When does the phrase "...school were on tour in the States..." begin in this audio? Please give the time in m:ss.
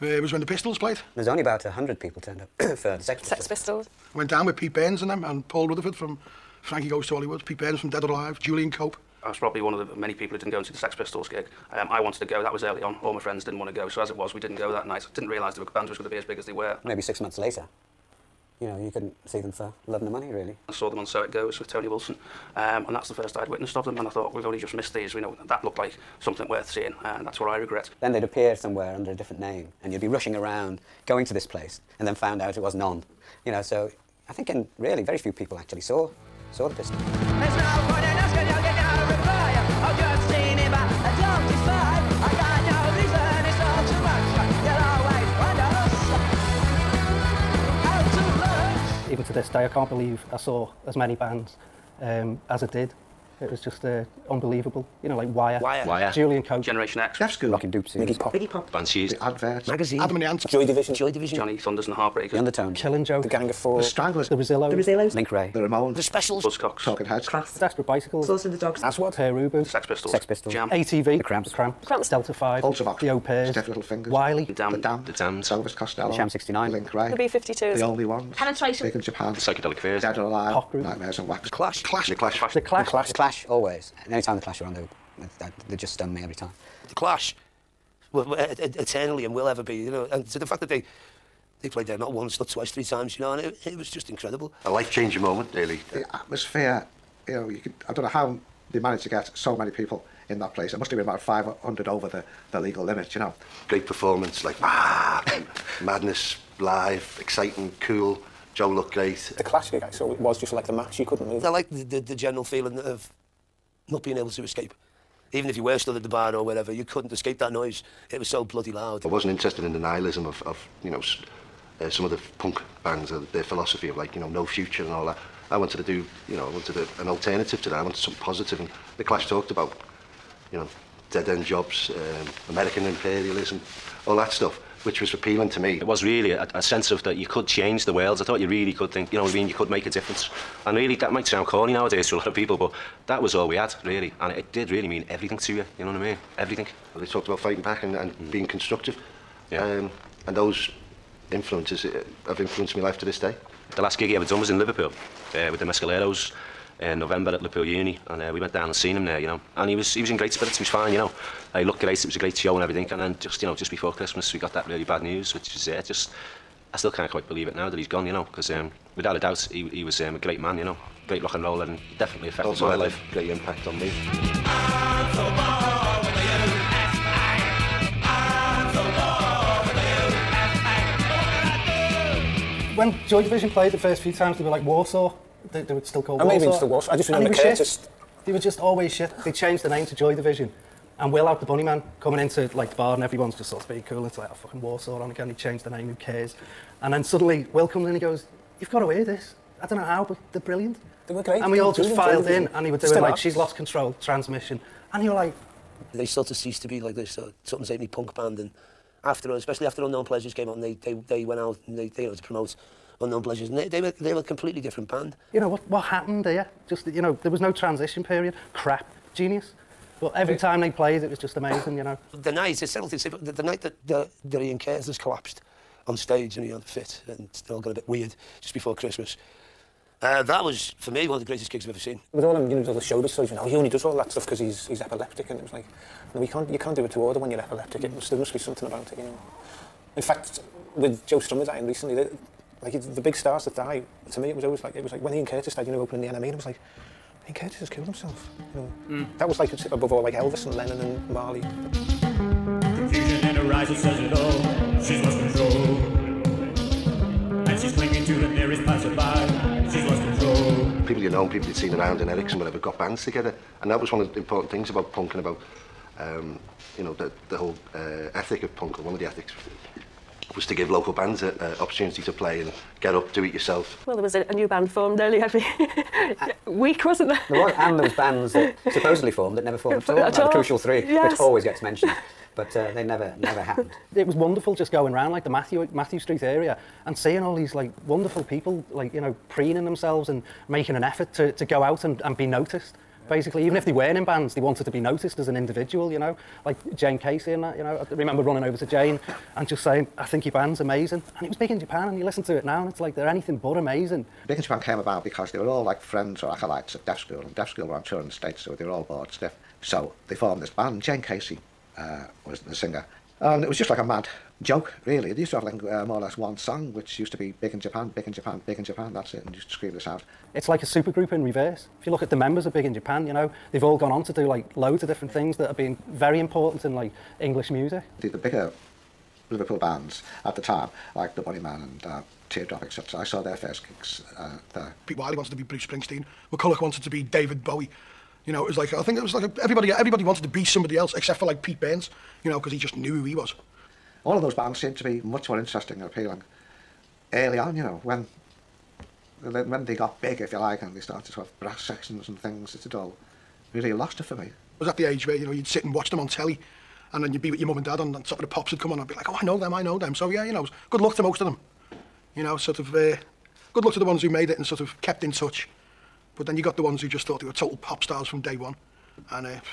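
5:07.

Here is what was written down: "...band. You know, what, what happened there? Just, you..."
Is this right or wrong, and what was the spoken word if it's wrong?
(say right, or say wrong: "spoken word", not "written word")
right.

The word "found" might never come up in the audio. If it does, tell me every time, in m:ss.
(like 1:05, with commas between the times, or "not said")
0:32.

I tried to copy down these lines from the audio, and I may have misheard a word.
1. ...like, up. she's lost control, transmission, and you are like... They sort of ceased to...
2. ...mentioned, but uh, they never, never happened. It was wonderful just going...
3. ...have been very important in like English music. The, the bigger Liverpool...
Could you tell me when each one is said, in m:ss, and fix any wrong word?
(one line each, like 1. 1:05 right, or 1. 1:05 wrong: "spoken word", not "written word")
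1. 3:23 right
2. 4:41 right
3. 5:25 right.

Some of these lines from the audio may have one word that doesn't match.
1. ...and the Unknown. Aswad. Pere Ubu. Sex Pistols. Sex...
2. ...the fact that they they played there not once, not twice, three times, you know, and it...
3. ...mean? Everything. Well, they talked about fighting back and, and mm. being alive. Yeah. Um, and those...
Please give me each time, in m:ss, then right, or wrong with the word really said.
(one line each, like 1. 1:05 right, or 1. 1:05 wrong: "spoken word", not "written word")
1. 1:08 wrong: "Dogs", not "Unknown"
2. 1:30 right
3. 2:26 wrong: "constructive", not "alive".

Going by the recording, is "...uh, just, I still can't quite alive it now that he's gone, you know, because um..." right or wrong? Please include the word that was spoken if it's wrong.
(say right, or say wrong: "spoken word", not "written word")
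wrong: "believe", not "alive".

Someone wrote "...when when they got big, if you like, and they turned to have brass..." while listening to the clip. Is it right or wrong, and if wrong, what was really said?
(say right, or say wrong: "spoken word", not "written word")
wrong: "started", not "turned".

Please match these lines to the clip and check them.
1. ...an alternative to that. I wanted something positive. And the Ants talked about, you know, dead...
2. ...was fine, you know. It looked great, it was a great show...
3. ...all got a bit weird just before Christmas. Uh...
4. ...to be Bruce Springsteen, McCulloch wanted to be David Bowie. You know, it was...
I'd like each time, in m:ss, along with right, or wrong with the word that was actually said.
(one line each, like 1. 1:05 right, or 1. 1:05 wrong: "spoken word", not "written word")
1. 2:07 wrong: "Clash", not "Ants"
2. 2:40 right
3. 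3:47 right
4. 5:35 right.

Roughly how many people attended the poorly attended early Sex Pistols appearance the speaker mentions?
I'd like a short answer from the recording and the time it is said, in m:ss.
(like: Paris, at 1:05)
100, at 0:01.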